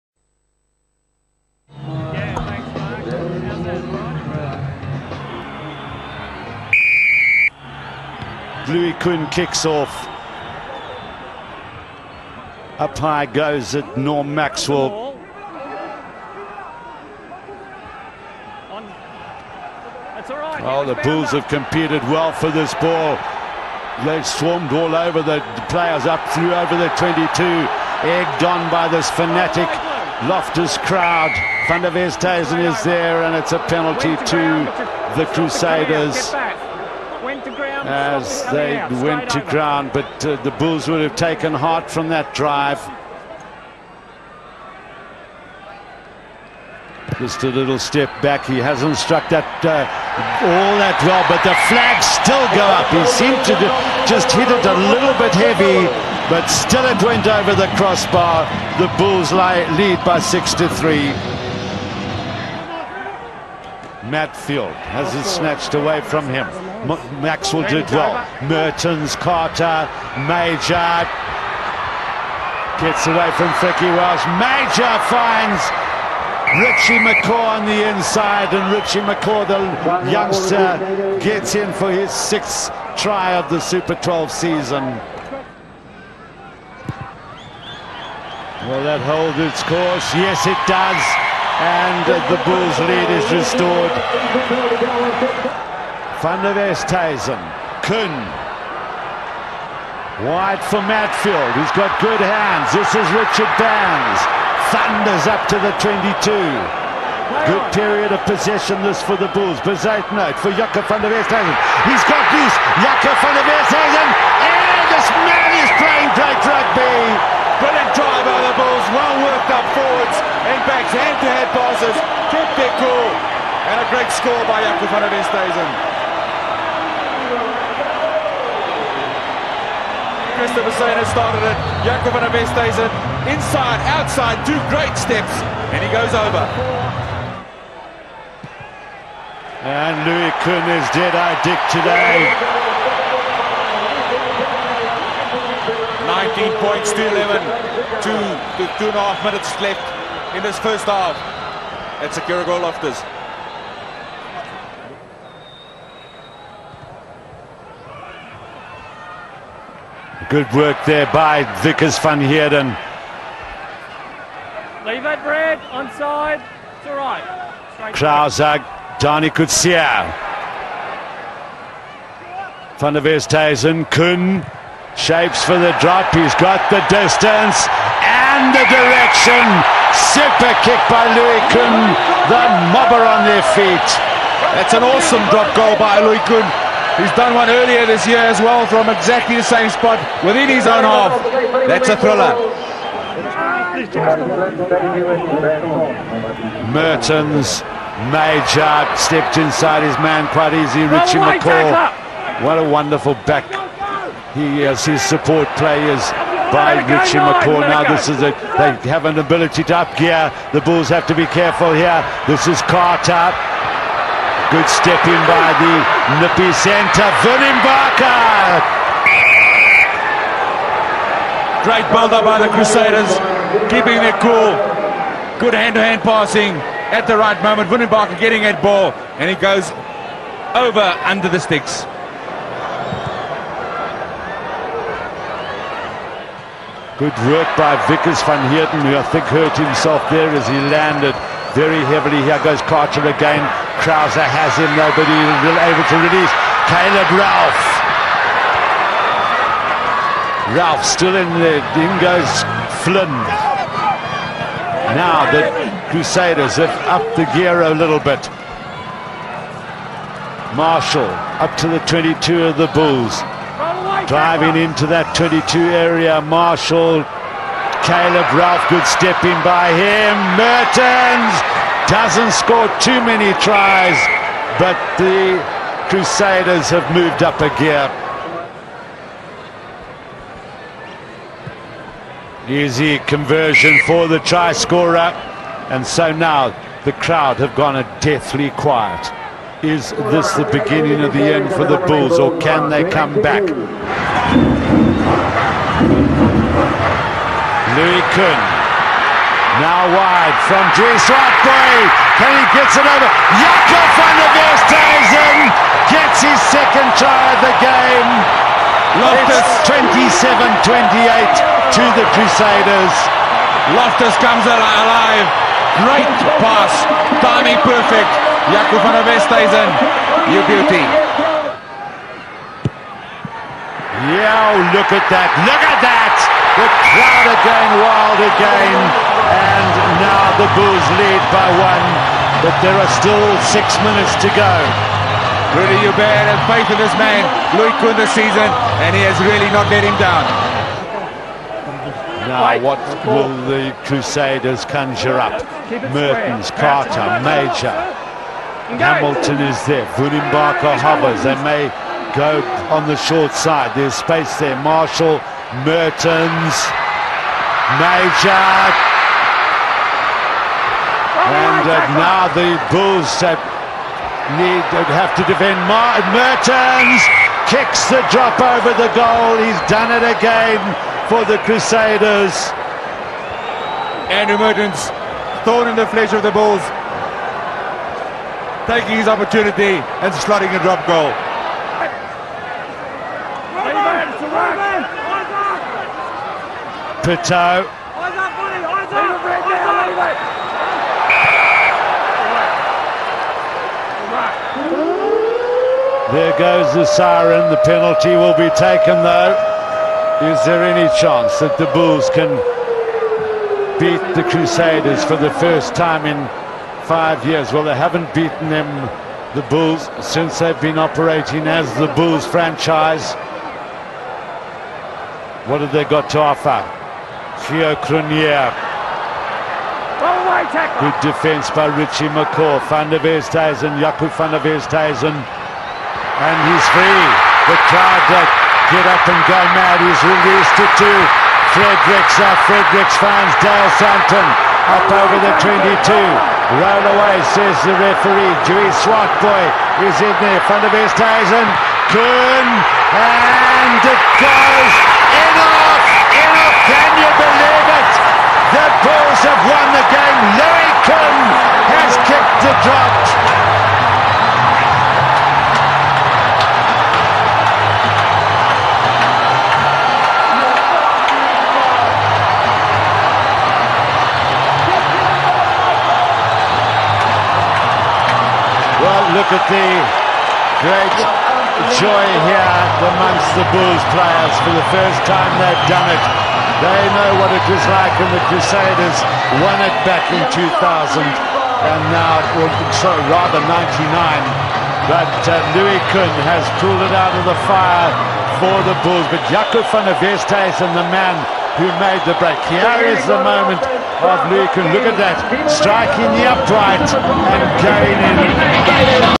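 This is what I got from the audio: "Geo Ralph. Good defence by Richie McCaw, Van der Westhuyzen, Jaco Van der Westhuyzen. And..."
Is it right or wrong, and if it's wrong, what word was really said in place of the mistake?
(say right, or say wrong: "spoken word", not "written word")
wrong: "Cronjé", not "Ralph".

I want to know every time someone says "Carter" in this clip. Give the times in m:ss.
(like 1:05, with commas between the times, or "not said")
1:09, 3:32, 4:02, 5:46.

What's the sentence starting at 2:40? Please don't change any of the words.
Good work there by Wikus van Heerden.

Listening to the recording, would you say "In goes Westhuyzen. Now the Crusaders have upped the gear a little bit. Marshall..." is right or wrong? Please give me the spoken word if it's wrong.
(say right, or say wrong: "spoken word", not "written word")
wrong: "Flynn", not "Westhuyzen".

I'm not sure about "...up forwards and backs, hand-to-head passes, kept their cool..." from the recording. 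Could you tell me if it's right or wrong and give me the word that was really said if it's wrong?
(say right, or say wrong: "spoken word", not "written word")
right.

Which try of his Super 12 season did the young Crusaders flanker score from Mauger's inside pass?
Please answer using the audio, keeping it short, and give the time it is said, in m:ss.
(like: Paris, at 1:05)
Sixth, at 1:22.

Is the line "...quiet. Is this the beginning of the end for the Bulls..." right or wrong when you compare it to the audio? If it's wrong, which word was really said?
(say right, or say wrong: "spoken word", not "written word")
right.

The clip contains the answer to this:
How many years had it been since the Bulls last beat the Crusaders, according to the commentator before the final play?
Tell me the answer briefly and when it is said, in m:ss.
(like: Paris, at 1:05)
5, at 6:46.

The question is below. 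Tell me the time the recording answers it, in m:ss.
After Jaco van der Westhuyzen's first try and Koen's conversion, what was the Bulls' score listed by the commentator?
2:26.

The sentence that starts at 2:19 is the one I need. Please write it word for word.
And Louis Koen is dead eye Dick today.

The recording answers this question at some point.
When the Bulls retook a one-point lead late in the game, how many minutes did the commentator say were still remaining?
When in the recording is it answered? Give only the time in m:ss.
5:33.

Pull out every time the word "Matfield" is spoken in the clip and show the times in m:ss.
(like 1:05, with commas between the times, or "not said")
1:04, 1:40.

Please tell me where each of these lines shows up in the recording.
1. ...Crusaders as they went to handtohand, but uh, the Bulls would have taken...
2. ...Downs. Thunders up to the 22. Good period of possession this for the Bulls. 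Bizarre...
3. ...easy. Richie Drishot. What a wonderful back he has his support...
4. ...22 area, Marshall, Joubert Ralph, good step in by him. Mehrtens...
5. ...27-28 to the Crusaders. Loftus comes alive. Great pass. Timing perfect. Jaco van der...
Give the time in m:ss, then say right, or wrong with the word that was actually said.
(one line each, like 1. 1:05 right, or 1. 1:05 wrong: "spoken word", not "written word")
1. 0:35 wrong: "ground", not "handtohand"
2. 1:43 right
3. 3:20 wrong: "McCaw", not "Drishot"
4. 4:25 wrong: "Caleb", not "Joubert"
5. 5:09 right.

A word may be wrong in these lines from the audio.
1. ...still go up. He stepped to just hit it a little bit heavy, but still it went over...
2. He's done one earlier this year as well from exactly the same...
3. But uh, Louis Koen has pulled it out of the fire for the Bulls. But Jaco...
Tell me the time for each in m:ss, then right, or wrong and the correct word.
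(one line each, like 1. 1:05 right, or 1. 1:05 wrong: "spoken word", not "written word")
1. 0:52 wrong: "seemed", not "stepped"
2. 3:06 right
3. 8:04 right.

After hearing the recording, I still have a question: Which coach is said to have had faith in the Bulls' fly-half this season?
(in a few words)
Rudy Joubert.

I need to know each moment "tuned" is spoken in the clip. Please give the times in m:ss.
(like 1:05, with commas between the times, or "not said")
not said.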